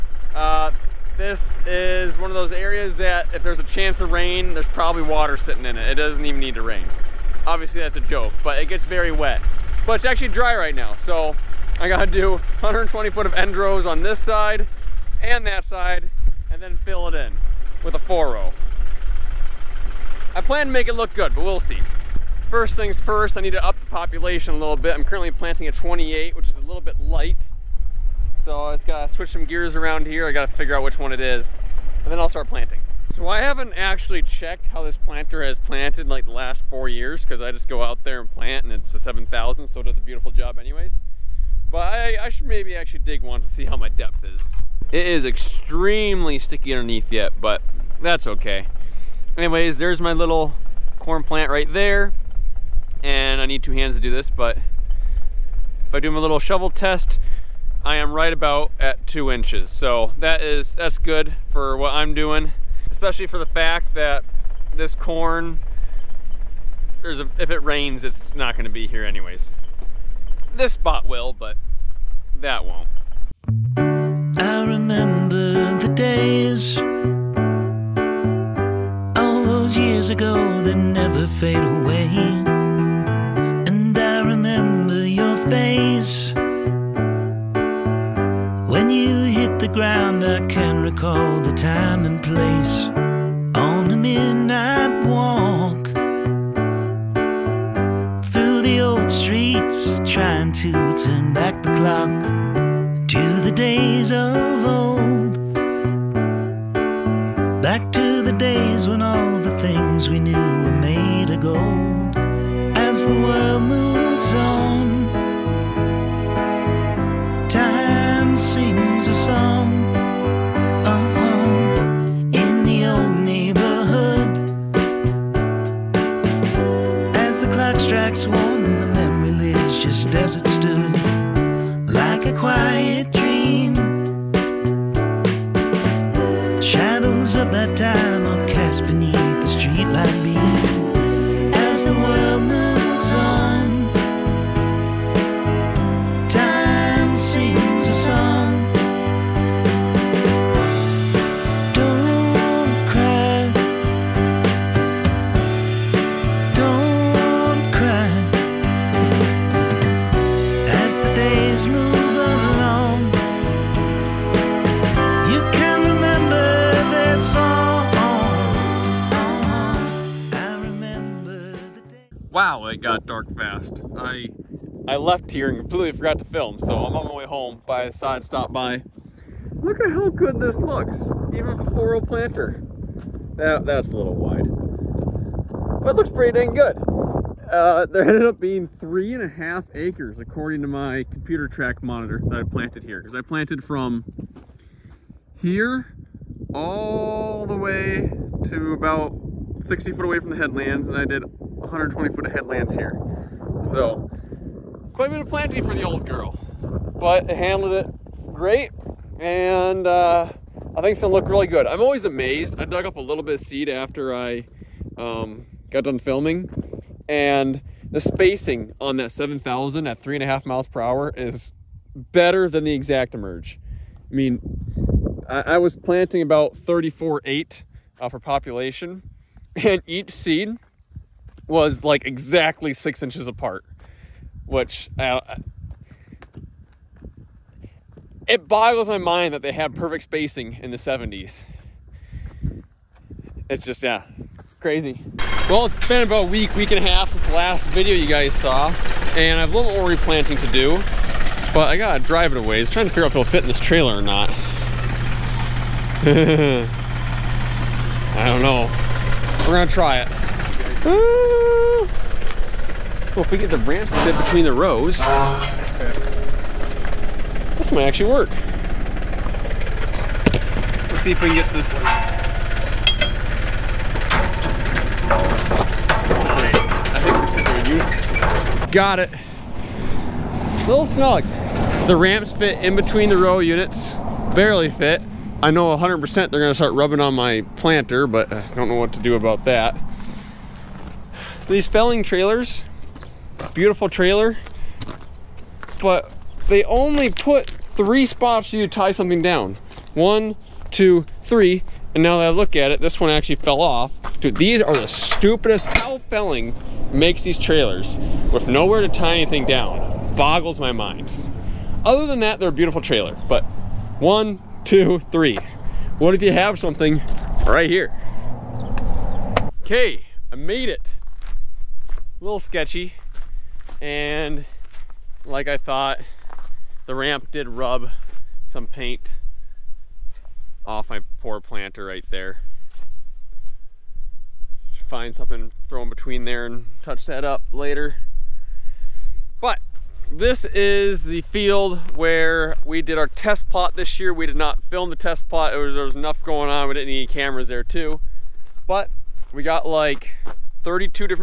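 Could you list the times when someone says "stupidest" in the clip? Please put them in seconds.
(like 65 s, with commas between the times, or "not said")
304 s.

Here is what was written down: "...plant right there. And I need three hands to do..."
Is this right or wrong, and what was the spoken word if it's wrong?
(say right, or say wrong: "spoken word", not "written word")
wrong: "two", not "three".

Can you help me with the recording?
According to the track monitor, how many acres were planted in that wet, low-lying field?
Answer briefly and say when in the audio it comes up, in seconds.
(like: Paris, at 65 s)
3.5 acres, at 188 s.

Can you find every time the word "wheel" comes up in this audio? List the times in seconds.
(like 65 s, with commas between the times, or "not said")
not said.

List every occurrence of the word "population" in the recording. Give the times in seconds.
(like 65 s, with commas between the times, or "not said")
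23 s, 228 s.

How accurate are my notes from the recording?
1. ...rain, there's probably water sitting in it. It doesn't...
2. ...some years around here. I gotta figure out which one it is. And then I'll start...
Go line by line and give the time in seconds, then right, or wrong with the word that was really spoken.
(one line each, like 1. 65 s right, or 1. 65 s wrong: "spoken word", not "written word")
1. 4 s right
2. 29 s wrong: "gears", not "years".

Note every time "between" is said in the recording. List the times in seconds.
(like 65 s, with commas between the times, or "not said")
264 s, 282 s, 335 s.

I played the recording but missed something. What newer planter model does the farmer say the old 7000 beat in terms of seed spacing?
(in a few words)
ExactEmerge.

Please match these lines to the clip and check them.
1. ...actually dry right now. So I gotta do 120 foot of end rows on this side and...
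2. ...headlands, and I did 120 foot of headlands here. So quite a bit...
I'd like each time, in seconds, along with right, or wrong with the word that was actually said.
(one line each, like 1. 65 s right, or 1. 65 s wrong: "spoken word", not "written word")
1. 10 s right
2. 200 s right.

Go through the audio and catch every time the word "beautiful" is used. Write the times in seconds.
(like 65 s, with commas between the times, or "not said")
39 s, 293 s, 312 s.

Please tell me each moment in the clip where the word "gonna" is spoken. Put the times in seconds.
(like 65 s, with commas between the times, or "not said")
211 s, 259 s, 286 s.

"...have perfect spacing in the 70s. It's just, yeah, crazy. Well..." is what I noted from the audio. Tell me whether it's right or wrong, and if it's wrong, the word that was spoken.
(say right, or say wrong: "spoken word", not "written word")
right.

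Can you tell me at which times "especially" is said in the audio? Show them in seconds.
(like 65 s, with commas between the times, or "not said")
62 s.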